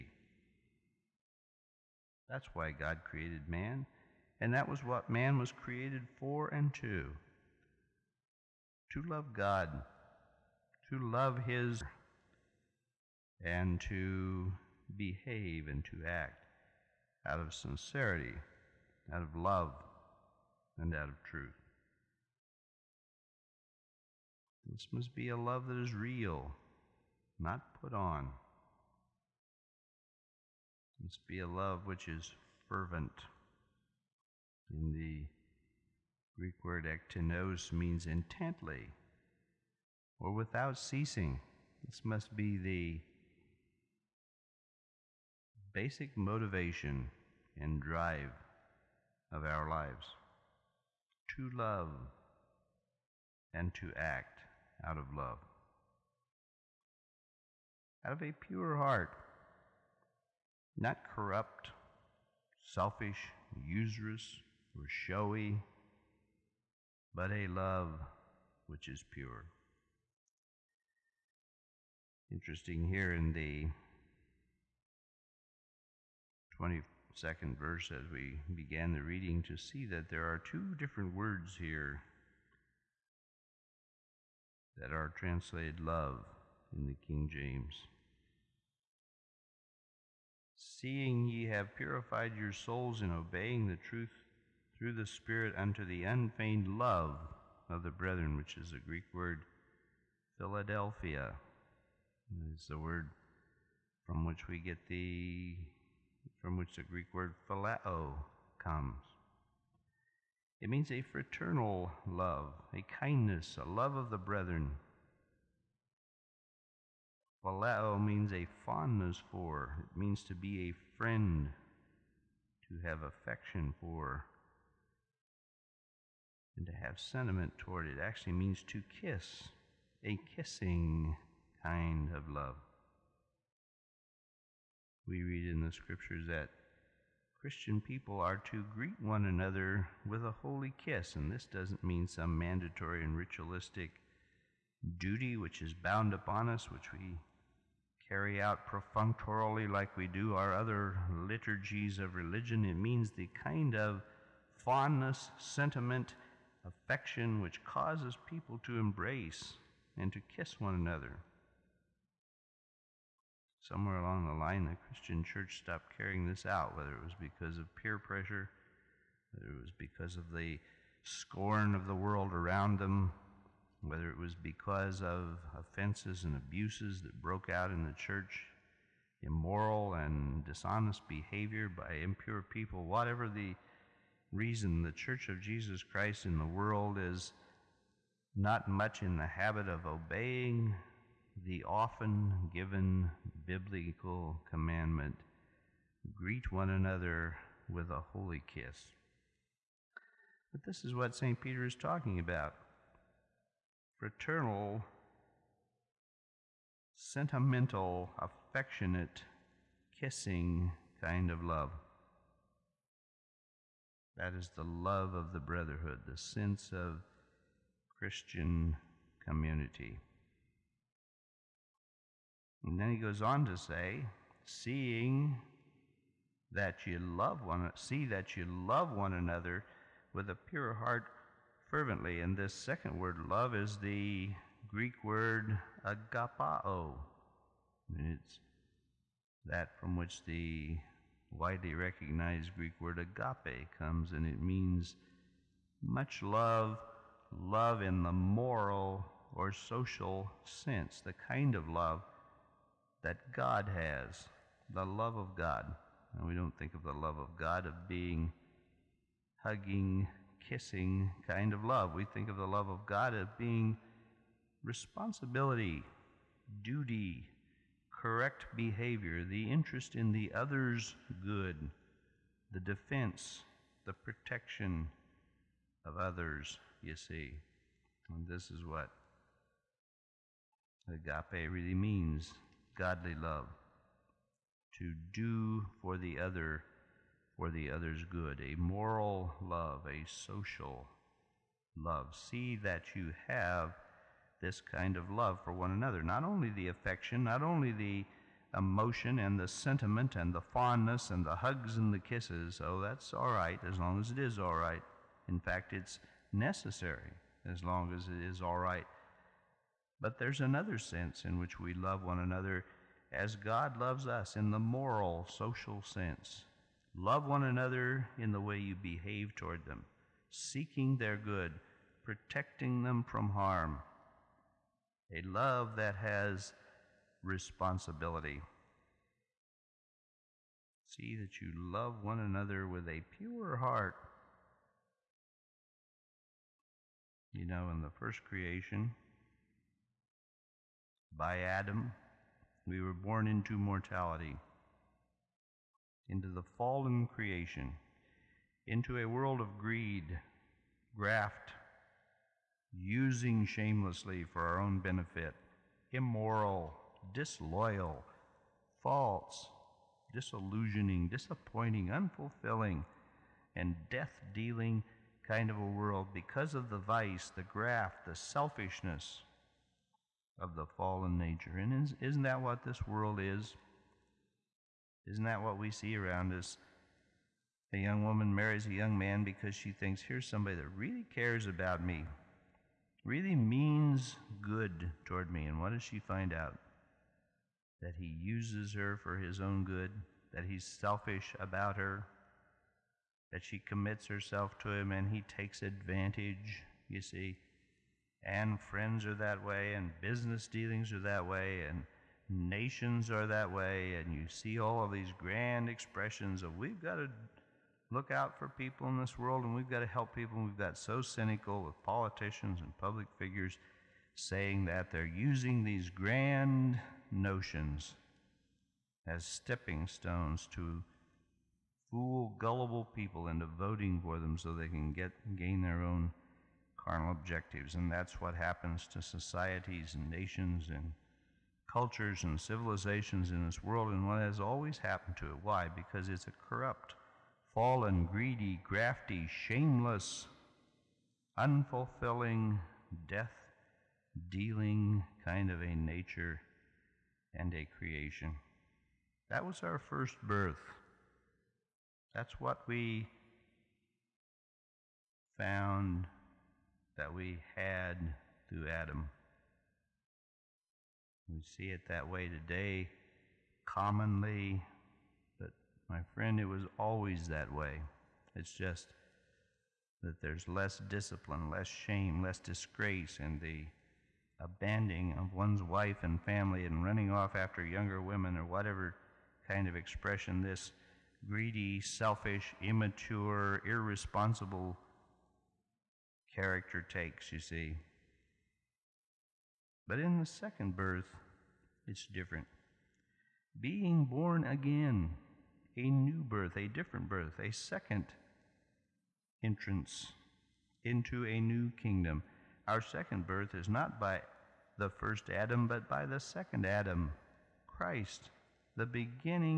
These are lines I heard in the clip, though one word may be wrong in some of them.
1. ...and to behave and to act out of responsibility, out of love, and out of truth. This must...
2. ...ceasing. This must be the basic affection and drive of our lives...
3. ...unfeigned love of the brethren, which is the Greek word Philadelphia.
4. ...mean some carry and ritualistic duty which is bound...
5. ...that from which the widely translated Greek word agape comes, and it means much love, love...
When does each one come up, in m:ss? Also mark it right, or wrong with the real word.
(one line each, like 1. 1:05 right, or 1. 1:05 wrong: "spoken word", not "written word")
1. 0:13 wrong: "sincerity", not "responsibility"
2. 0:40 wrong: "motivation", not "affection"
3. 1:36 right
4. 2:21 wrong: "mandatory", not "carry"
5. 3:59 wrong: "recognized", not "translated".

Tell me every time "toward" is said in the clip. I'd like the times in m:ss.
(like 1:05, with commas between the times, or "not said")
2:07, 5:19, 6:25.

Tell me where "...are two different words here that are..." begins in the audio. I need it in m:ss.
1:20.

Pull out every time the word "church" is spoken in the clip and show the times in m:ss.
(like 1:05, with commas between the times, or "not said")
2:45, 2:57, 3:04.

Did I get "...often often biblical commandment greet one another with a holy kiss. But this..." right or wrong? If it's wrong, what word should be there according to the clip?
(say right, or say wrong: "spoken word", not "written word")
wrong: "given", not "often".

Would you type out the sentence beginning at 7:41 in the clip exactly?
We see it that way today commonly my friend, it was always that way.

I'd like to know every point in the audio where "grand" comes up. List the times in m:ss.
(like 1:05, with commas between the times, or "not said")
6:45, 6:55.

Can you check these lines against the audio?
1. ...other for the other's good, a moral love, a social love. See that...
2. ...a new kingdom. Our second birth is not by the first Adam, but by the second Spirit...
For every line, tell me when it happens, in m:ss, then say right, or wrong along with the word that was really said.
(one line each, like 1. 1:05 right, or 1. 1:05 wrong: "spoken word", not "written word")
1. 4:46 right
2. 8:21 wrong: "Adam", not "Spirit".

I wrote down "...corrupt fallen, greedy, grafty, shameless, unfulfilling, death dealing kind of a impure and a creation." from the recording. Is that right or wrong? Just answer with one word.
wrong.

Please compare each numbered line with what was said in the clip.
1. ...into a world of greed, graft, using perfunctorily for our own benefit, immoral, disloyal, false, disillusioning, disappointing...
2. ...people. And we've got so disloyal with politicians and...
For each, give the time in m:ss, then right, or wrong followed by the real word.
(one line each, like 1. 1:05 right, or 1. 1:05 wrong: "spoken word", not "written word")
1. 5:48 wrong: "shamelessly", not "perfunctorily"
2. 6:50 wrong: "cynical", not "disloyal".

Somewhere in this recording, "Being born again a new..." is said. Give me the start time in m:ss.
8:13.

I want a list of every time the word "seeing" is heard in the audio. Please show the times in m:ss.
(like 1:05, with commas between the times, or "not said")
1:30, 3:44.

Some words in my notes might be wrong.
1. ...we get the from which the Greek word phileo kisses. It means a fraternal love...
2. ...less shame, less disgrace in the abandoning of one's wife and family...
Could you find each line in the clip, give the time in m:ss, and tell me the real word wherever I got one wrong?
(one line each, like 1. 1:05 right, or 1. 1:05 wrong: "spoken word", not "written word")
1. 1:44 wrong: "comes", not "kisses"
2. 7:51 right.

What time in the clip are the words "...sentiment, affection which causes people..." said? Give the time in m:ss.
2:35.